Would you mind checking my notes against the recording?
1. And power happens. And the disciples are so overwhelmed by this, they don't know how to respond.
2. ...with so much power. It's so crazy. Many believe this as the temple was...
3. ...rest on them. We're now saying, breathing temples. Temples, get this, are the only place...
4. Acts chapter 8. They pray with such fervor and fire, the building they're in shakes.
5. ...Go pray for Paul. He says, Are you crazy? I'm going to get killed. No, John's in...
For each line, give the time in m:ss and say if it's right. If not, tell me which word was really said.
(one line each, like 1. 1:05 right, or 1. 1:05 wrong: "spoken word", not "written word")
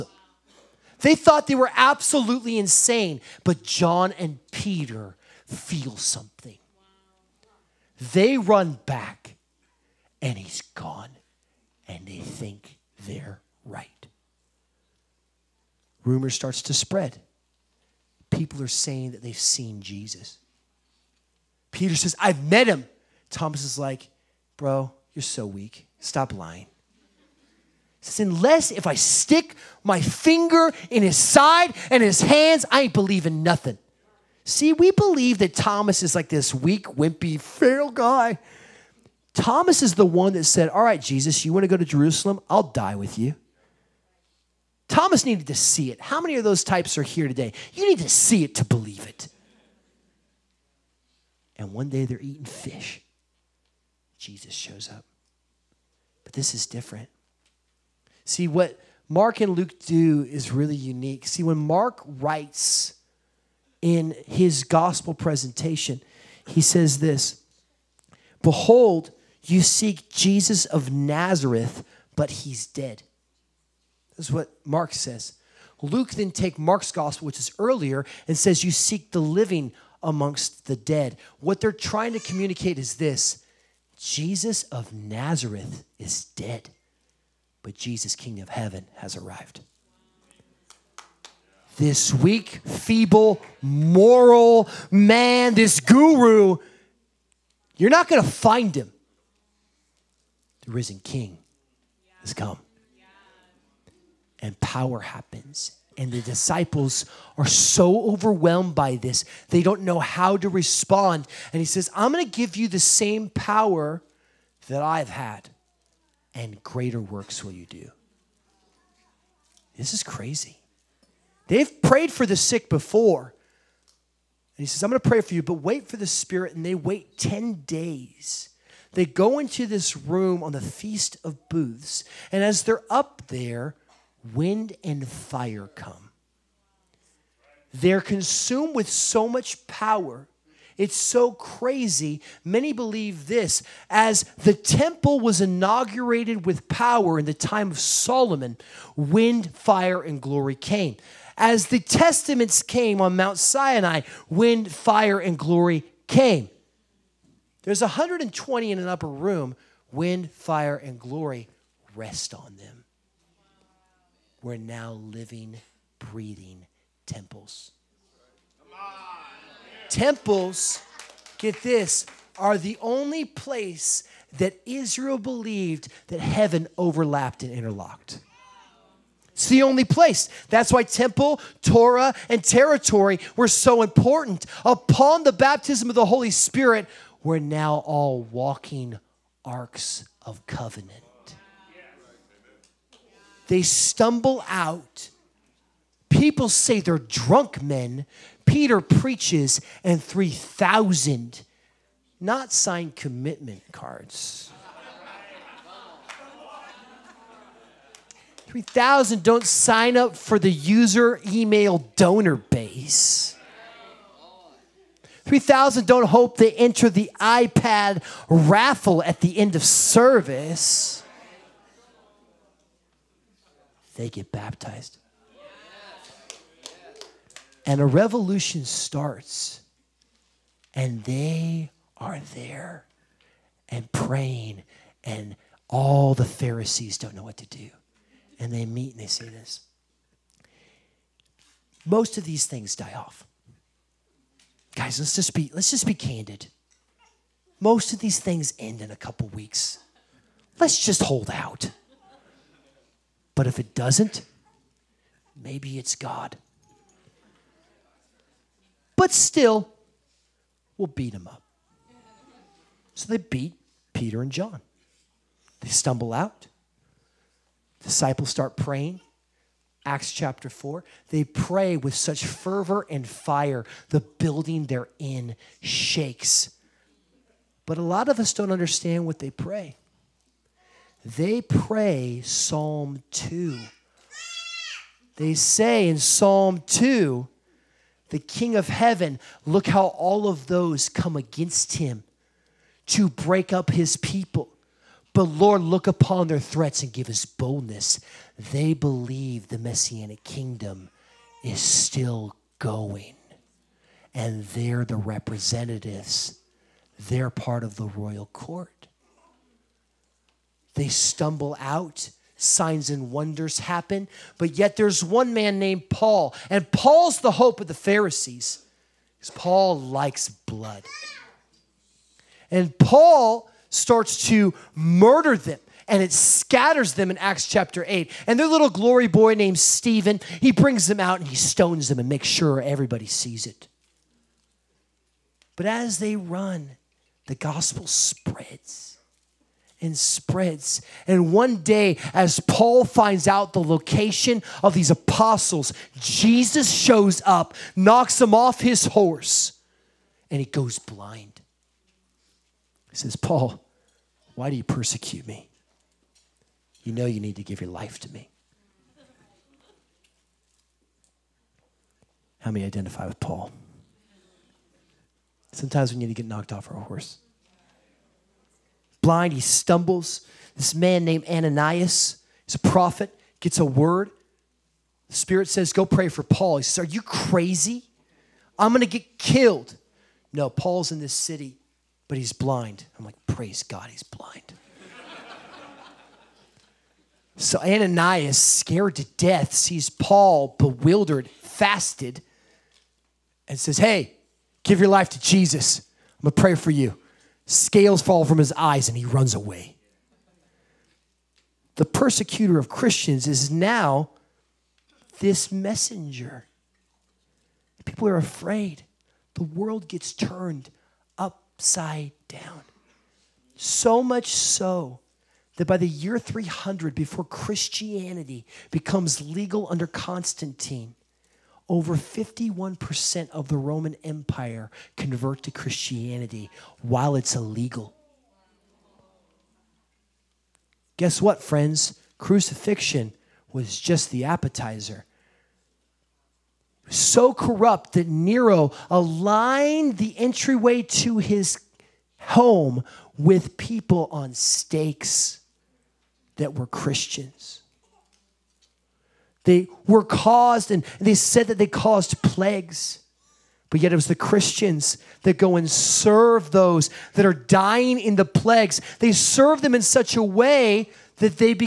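1. 1:44 right
2. 2:18 right
3. 2:41 wrong: "living", not "saying"
4. 4:29 wrong: "4", not "8"
5. 6:15 wrong: "Paul", not "John".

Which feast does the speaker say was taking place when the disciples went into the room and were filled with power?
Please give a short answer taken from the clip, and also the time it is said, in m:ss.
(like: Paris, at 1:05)
Feast of Booths, at 2:10.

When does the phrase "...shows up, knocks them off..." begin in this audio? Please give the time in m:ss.
5:46.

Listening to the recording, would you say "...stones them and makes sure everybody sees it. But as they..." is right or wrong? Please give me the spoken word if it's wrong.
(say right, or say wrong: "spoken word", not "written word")
right.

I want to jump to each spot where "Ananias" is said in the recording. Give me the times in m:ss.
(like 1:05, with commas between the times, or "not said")
6:11, 6:27.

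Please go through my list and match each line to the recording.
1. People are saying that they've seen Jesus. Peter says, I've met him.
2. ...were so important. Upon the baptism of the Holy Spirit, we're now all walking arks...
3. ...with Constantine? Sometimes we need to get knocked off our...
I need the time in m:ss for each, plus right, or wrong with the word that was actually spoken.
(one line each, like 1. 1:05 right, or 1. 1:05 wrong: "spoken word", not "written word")
1. 0:18 right
2. 3:03 right
3. 6:03 wrong: "Paul", not "Constantine".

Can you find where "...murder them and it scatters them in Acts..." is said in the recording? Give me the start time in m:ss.
5:24.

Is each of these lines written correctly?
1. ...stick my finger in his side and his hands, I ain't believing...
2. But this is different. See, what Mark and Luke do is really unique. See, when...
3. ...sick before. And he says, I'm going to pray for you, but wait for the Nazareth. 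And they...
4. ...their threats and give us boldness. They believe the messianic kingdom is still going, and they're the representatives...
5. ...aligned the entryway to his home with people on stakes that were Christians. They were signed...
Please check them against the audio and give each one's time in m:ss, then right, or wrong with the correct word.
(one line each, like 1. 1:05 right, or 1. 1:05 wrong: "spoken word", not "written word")
1. 0:28 right
2. 0:56 right
3. 2:02 wrong: "Spirit", not "Nazareth"
4. 4:56 right
5. 7:18 wrong: "caused", not "signed".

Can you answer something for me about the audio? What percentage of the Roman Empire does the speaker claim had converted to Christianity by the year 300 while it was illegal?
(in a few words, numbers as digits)
51%.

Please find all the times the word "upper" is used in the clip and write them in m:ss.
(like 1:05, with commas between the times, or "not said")
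2:38.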